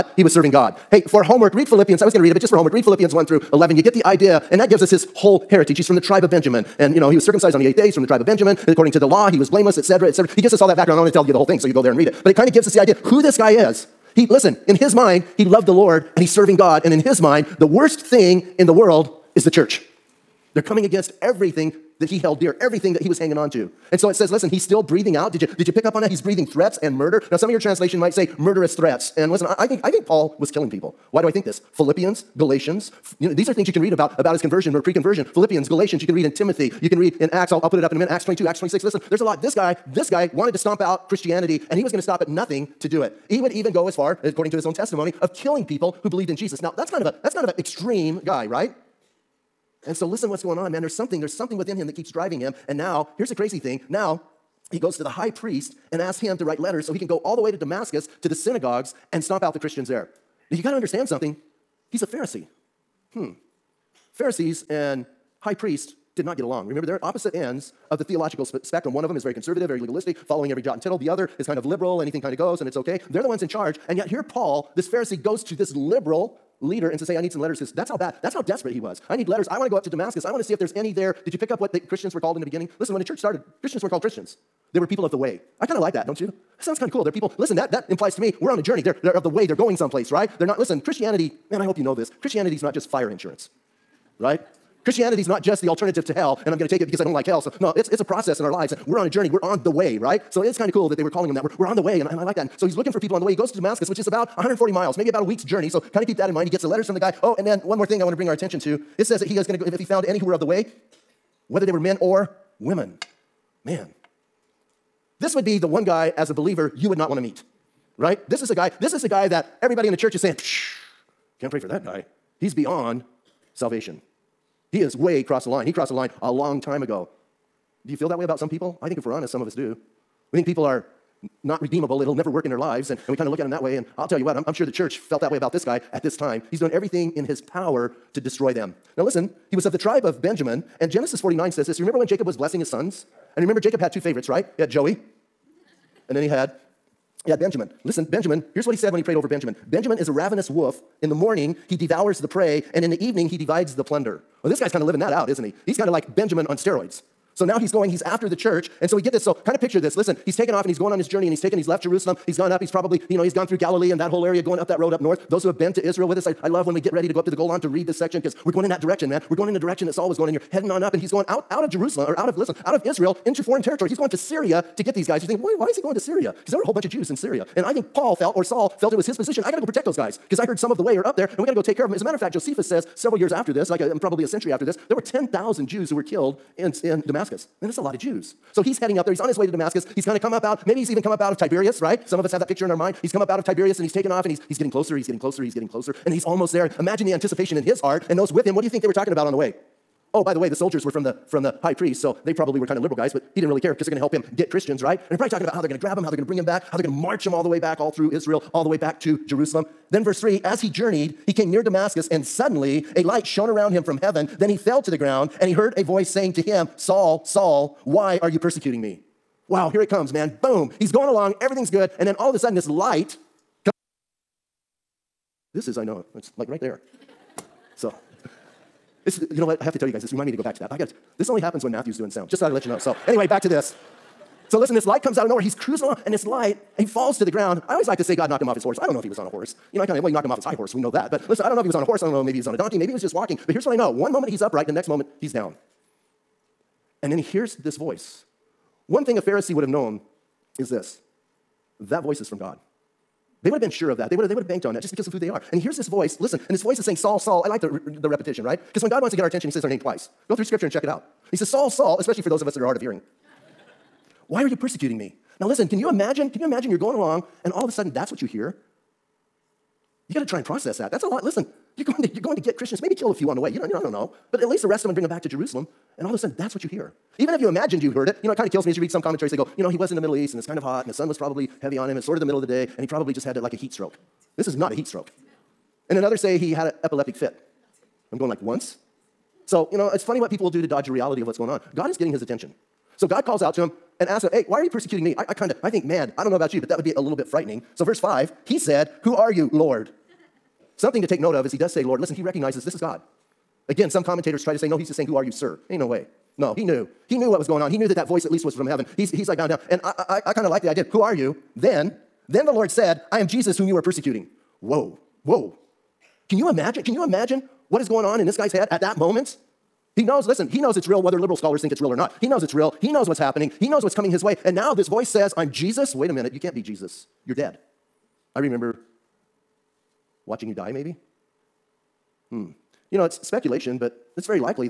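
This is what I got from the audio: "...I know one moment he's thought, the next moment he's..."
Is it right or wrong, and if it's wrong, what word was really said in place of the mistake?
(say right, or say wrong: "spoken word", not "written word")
wrong: "upright", not "thought".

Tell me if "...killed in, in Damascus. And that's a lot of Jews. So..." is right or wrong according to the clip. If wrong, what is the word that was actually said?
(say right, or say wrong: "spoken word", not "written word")
right.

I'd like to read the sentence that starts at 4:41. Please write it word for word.
It's sort of the middle of the day and he probably just had like a heat stroke.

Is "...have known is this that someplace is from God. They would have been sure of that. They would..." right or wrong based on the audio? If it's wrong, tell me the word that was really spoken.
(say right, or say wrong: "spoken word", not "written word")
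wrong: "voice", not "someplace".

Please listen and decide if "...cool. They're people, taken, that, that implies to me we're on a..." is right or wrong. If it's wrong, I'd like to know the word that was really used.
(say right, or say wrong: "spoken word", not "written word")
wrong: "listen", not "taken".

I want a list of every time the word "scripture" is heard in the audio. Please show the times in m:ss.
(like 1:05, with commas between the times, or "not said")
4:20.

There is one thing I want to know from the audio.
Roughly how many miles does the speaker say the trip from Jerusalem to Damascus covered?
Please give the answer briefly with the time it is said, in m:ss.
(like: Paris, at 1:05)
140, at 1:44.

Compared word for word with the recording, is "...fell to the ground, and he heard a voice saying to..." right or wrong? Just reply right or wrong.
right.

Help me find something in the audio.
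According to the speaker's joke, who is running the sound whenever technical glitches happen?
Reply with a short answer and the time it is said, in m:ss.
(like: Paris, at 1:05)
Matthew, at 3:51.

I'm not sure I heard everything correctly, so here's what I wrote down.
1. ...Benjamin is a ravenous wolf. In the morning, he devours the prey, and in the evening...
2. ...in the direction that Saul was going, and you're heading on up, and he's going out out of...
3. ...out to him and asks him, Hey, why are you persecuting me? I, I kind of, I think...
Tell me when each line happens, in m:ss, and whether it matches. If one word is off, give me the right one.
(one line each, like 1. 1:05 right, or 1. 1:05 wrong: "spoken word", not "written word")
1. 2:29 right
2. 2:49 right
3. 4:53 right.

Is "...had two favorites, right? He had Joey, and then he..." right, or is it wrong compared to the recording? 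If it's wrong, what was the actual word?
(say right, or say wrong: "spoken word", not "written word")
right.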